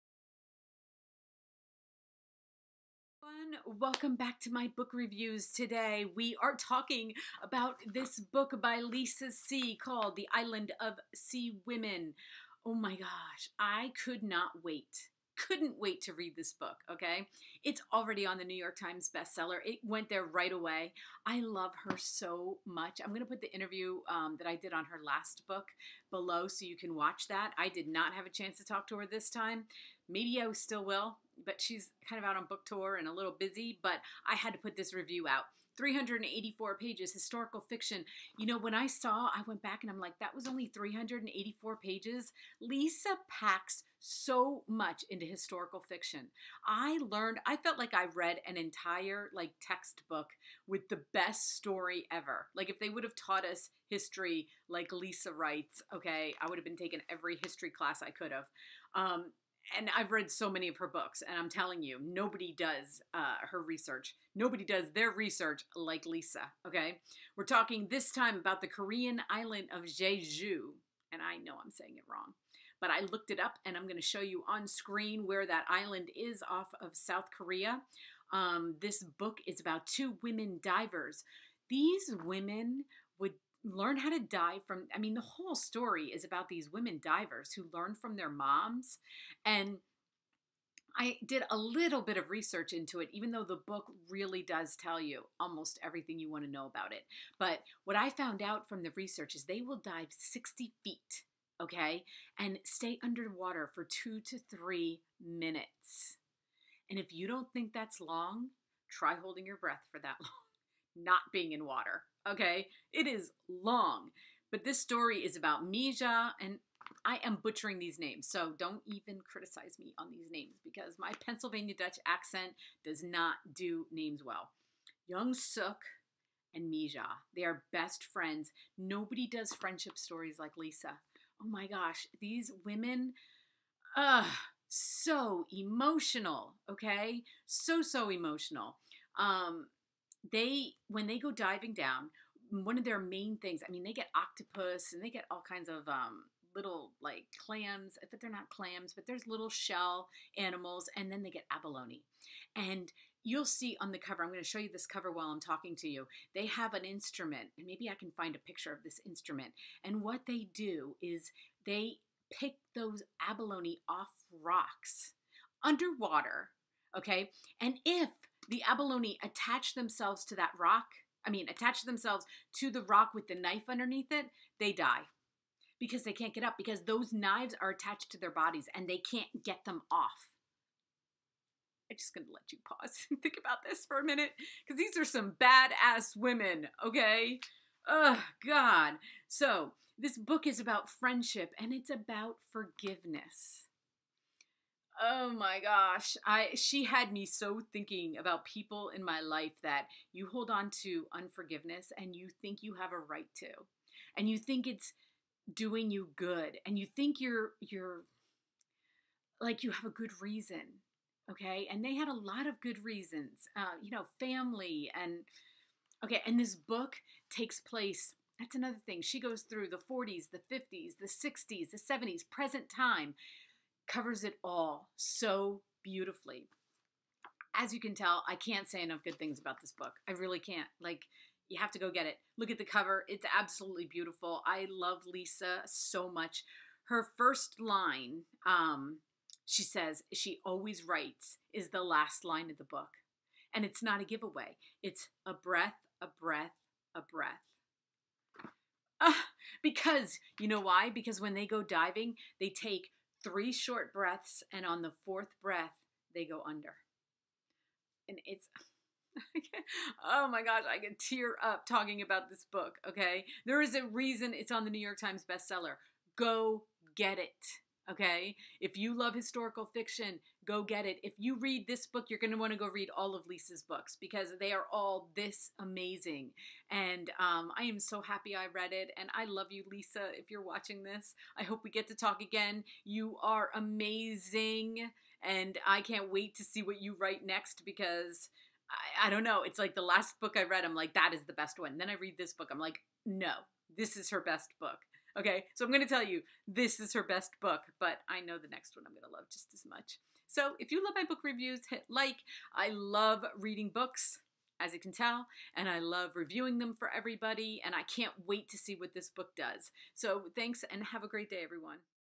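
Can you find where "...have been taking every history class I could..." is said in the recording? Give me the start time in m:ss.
0:56.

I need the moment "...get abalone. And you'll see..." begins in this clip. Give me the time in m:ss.
2:31.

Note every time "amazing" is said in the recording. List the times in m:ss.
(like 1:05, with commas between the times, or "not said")
4:35, 4:43.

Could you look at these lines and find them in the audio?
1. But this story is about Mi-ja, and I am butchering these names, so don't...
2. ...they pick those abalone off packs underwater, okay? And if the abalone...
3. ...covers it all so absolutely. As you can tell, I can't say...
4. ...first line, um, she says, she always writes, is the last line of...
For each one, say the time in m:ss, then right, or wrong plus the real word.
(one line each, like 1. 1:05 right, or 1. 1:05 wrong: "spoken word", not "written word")
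1. 1:54 right
2. 2:41 wrong: "rocks", not "packs"
3. 3:43 wrong: "beautifully", not "absolutely"
4. 3:57 right.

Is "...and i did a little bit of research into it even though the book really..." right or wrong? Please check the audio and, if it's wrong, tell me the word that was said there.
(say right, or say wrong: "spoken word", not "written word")
right.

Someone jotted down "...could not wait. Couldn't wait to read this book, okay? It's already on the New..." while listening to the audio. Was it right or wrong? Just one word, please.
right.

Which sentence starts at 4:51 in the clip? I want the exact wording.
Then I read this book, I'm like, no, this is her best book.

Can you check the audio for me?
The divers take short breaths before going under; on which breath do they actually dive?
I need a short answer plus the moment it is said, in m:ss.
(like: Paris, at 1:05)
fourth, at 4:15.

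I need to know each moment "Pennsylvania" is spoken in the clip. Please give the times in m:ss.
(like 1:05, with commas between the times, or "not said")
2:01.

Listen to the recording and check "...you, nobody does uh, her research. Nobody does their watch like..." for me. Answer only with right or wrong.
wrong.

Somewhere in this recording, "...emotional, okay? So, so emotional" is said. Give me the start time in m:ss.
2:15.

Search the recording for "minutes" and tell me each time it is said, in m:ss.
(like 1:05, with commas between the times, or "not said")
1:45, 3:04.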